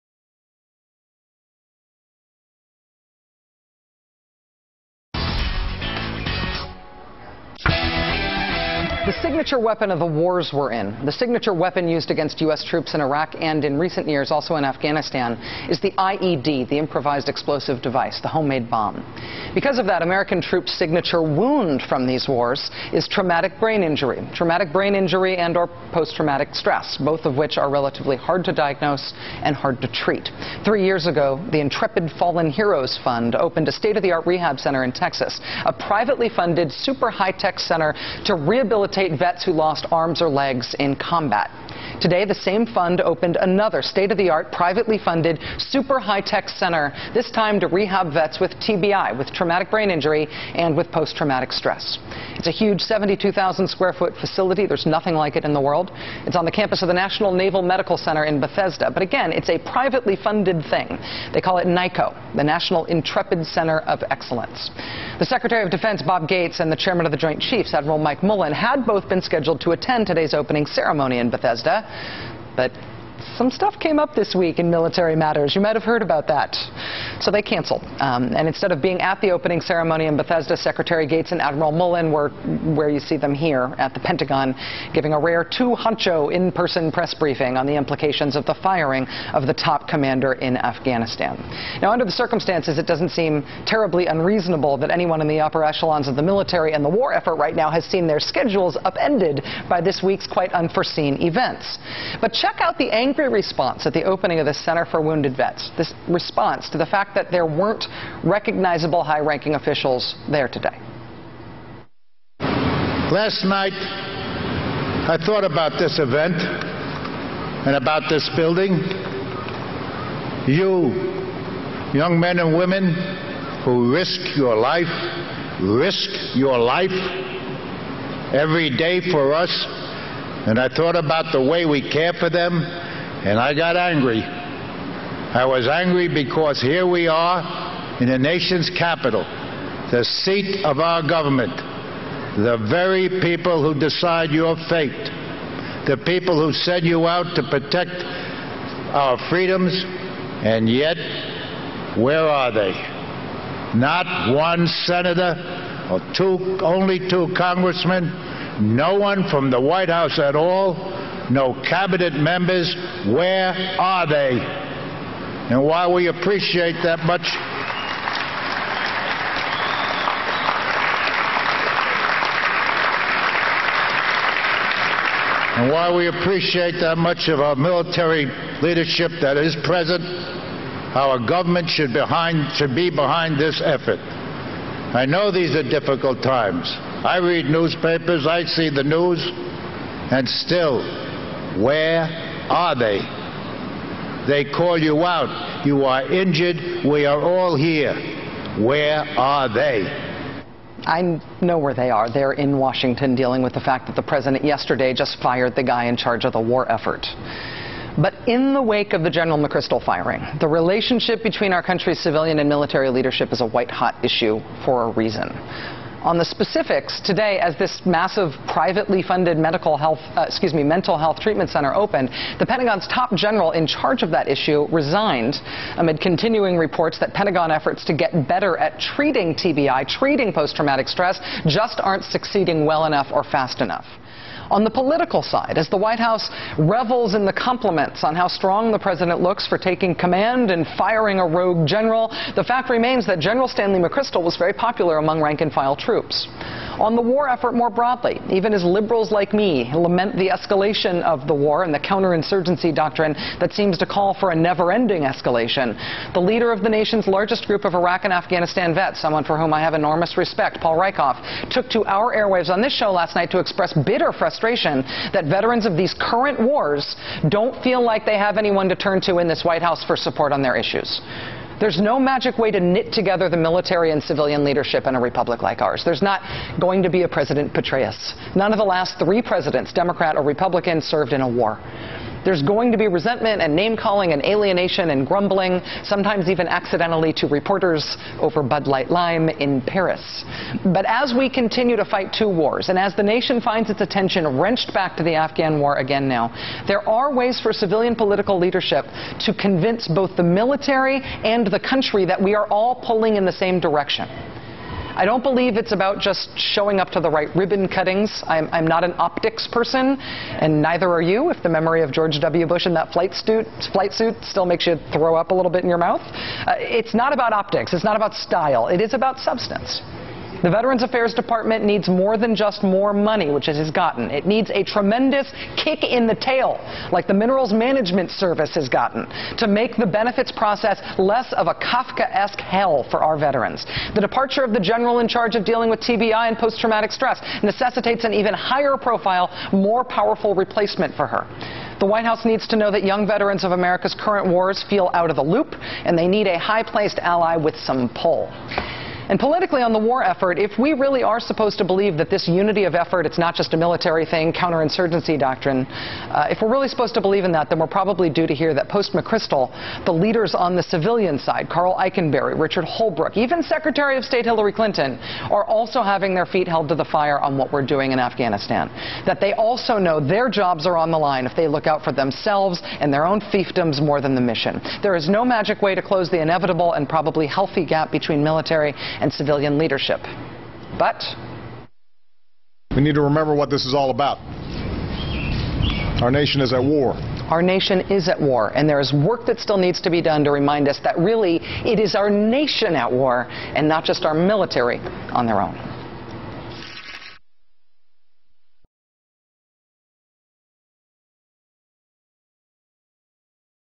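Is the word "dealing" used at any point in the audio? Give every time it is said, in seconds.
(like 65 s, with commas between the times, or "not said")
203 s, 335 s.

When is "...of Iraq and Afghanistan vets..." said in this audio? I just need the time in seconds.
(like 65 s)
257 s.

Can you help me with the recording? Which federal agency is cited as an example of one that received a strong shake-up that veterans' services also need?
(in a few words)
Minerals Management Service.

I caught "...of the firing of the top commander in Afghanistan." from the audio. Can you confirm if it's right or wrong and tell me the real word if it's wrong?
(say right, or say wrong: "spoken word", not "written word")
right.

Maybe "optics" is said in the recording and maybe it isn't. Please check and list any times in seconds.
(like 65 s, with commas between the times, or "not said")
308 s, 317 s.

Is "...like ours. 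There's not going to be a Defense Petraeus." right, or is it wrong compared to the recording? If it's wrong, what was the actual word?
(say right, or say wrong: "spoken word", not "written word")
wrong: "President", not "Defense".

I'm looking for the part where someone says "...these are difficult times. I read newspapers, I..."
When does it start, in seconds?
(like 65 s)
185 s.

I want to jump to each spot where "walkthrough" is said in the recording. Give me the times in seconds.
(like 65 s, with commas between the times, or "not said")
not said.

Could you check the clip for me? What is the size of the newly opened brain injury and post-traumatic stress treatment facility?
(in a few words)
72,000 square foot.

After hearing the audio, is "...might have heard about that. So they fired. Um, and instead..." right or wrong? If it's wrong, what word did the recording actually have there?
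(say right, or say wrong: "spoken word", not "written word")
wrong: "canceled", not "fired".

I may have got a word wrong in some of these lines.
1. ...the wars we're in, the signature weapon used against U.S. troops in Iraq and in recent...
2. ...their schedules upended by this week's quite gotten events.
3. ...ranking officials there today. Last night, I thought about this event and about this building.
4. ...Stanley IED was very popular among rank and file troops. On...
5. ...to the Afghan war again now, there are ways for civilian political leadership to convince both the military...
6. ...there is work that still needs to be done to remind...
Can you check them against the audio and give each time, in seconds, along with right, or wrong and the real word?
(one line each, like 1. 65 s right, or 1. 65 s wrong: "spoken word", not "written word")
1. 9 s right
2. 98 s wrong: "unforeseen", not "gotten"
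3. 109 s right
4. 243 s wrong: "McChrystal", not "IED"
5. 294 s right
6. 388 s right.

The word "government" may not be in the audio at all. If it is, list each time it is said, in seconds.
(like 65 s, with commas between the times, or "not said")
141 s, 181 s.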